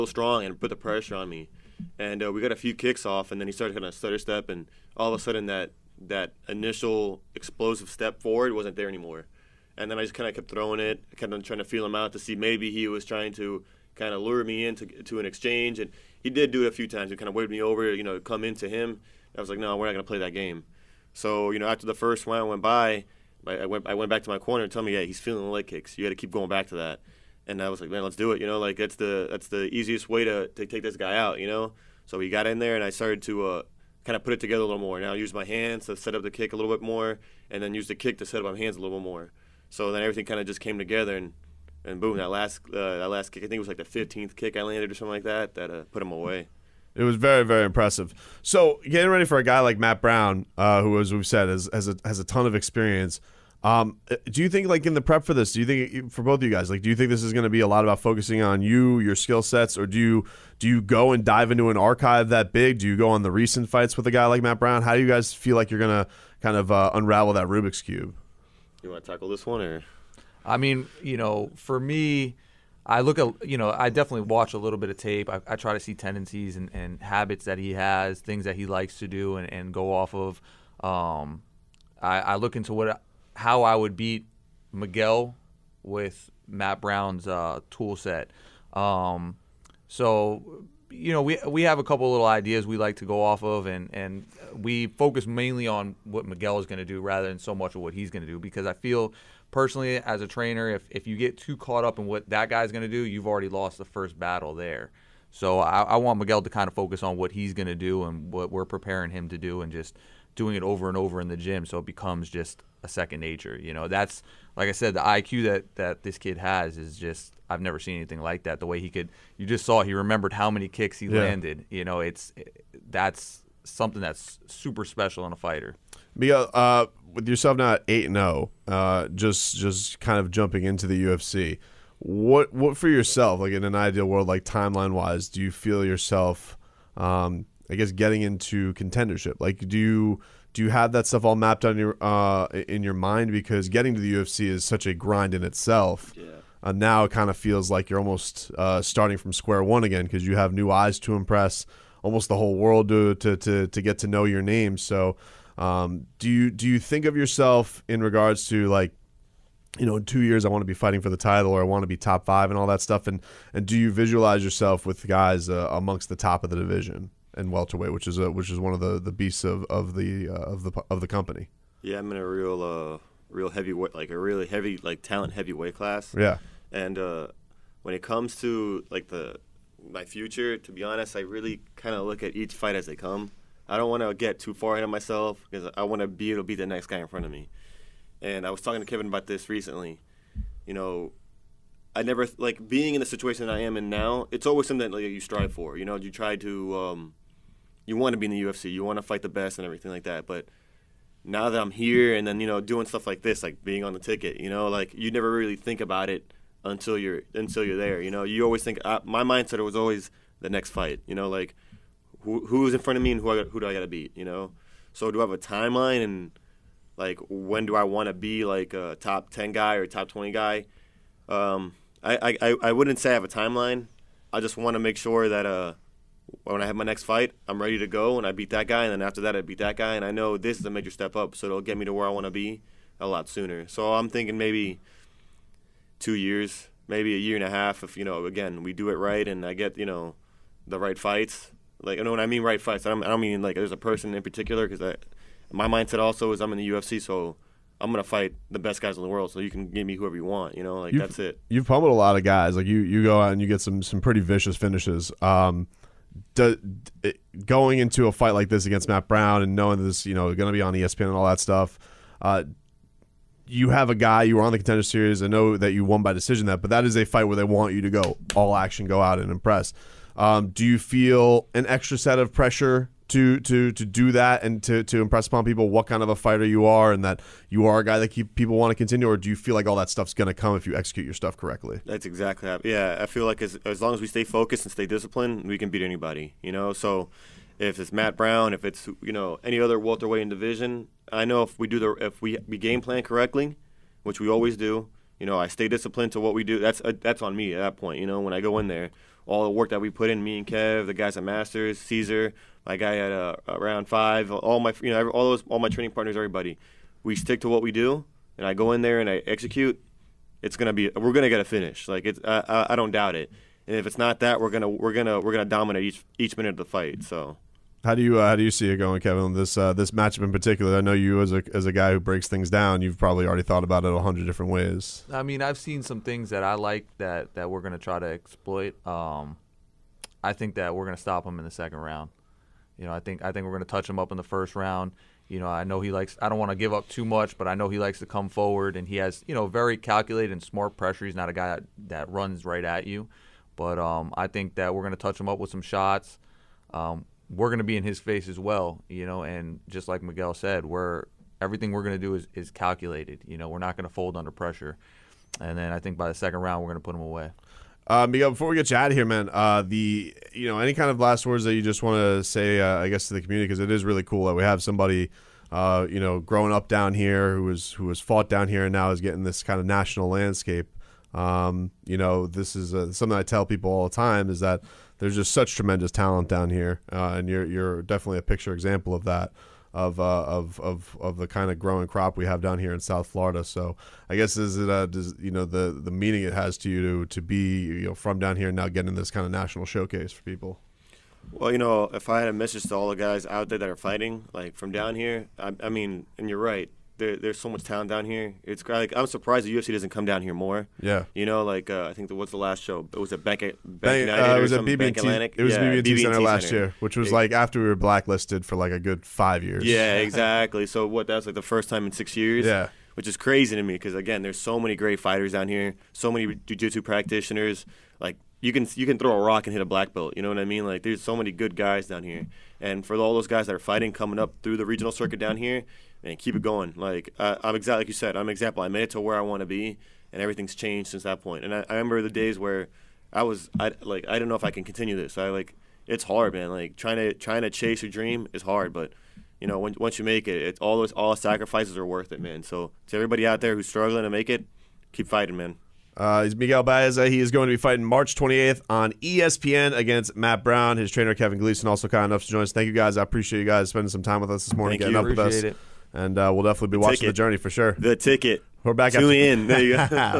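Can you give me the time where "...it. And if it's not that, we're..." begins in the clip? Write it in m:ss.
5:13.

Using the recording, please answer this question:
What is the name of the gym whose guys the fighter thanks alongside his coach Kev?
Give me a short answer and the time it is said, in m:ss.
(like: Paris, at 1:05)
Masters, at 5:01.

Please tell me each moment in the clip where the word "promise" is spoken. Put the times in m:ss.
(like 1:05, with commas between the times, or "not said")
not said.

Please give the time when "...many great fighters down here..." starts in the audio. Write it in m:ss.
6:54.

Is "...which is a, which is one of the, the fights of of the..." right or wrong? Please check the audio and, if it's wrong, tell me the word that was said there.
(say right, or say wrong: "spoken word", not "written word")
wrong: "beasts", not "fights".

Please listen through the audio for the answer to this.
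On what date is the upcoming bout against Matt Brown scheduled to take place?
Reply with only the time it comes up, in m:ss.
7:27.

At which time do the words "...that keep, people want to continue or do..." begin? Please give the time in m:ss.
4:37.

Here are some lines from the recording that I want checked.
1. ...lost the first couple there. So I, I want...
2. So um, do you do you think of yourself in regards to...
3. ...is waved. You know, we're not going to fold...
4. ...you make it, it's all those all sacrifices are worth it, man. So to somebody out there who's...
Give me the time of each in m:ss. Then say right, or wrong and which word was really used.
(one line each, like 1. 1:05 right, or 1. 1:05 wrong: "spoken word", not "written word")
1. 1:43 wrong: "battle", not "couple"
2. 2:34 right
3. 5:52 wrong: "calculated", not "waved"
4. 7:19 wrong: "everybody", not "somebody".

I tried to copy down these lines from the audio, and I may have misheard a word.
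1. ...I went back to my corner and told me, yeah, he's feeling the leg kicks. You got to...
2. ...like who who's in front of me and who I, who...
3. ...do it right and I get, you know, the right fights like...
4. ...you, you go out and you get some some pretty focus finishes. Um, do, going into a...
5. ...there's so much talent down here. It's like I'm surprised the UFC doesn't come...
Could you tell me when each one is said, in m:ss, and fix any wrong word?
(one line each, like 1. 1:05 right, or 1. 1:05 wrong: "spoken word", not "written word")
1. 0:23 right
2. 3:31 right
3. 3:58 right
4. 4:12 wrong: "vicious", not "focus"
5. 6:37 right.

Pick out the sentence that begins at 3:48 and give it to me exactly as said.
And then after that, I beat that guy.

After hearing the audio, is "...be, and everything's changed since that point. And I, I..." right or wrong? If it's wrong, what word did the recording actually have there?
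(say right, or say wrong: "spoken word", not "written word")
right.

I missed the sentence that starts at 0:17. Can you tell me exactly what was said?
He kind of waved me over, you know, come into him.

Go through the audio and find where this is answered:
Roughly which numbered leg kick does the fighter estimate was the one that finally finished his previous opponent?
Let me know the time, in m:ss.
0:43.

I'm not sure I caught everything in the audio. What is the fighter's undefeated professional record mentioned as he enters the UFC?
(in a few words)
8-0.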